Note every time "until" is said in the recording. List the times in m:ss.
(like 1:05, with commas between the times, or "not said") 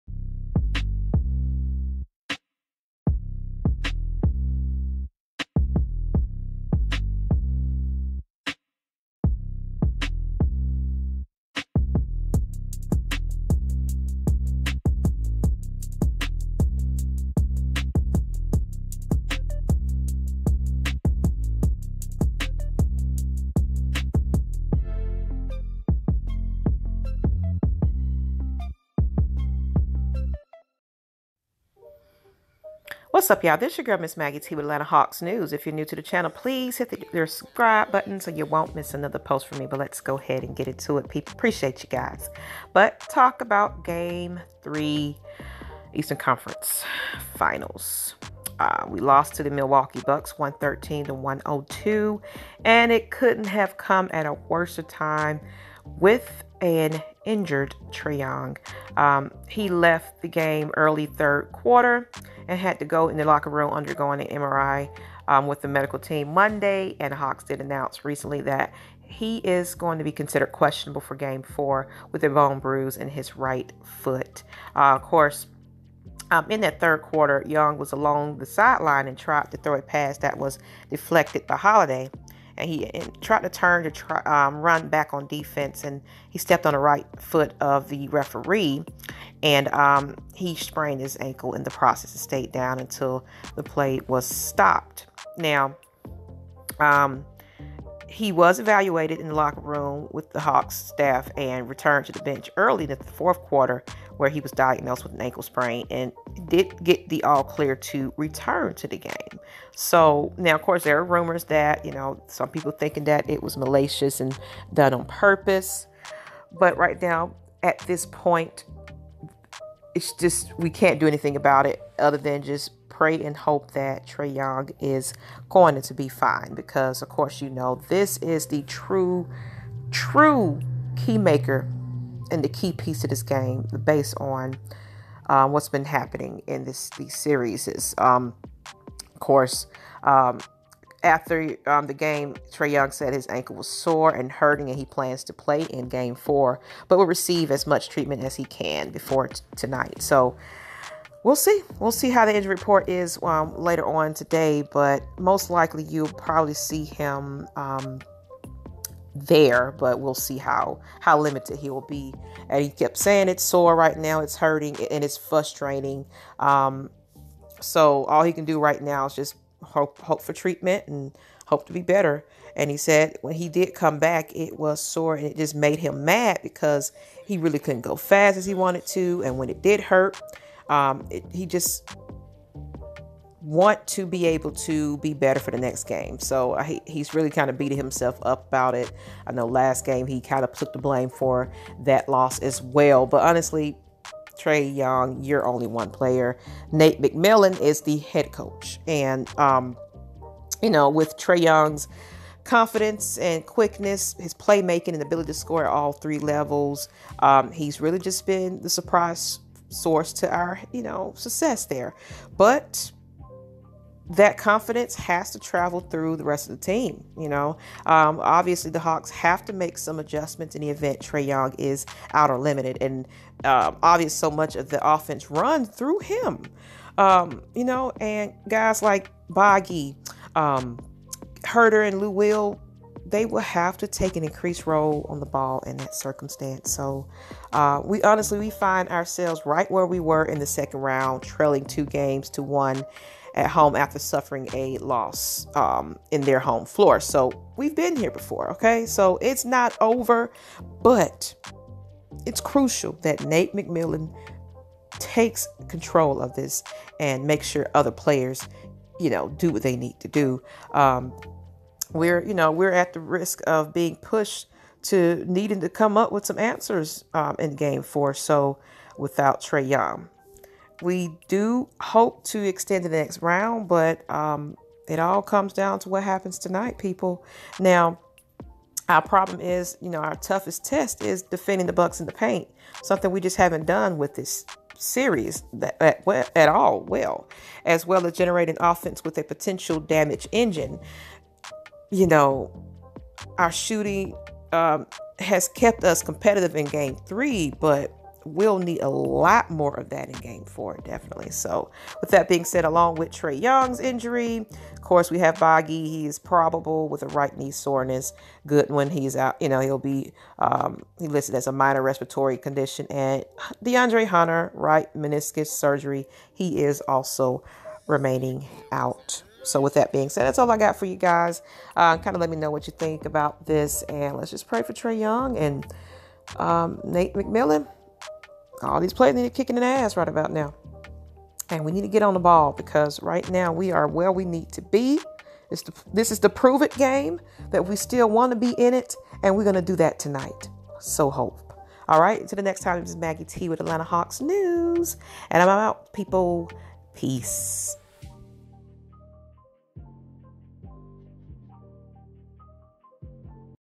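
1:32, 5:42.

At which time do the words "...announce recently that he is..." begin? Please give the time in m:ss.
1:07.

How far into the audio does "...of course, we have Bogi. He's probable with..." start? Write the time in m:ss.
5:04.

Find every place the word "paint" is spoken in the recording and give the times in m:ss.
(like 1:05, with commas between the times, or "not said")
4:42.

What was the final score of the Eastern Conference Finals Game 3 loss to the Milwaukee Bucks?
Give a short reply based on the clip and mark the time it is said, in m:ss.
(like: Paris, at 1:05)
113 to 102, at 0:50.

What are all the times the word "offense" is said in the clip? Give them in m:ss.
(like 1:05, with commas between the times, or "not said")
3:44, 4:48.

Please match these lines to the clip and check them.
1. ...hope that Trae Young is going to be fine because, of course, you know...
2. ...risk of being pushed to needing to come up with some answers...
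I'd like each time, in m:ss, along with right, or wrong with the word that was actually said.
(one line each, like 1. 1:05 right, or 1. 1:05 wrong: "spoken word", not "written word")
1. 2:03 right
2. 4:22 right.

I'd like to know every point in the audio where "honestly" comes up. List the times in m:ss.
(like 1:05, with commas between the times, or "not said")
3:13, 3:58.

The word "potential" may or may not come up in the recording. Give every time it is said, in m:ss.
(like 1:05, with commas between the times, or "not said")
4:49.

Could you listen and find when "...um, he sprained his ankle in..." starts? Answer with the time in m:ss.
1:29.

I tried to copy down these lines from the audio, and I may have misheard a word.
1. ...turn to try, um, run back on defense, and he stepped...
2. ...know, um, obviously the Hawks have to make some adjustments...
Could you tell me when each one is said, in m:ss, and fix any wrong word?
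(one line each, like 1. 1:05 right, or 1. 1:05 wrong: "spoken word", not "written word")
1. 1:23 right
2. 3:37 right.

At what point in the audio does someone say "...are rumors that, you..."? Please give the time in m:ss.
1:50.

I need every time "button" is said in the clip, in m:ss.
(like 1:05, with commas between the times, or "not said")
0:37.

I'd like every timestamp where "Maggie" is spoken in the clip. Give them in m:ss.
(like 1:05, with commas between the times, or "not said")
0:34, 5:42.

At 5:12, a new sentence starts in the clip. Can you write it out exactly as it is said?
And DeAndre Hunter, right meniscus surgery, he is also remaining out.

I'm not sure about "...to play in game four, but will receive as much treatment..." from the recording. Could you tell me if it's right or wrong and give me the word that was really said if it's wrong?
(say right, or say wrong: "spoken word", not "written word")
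right.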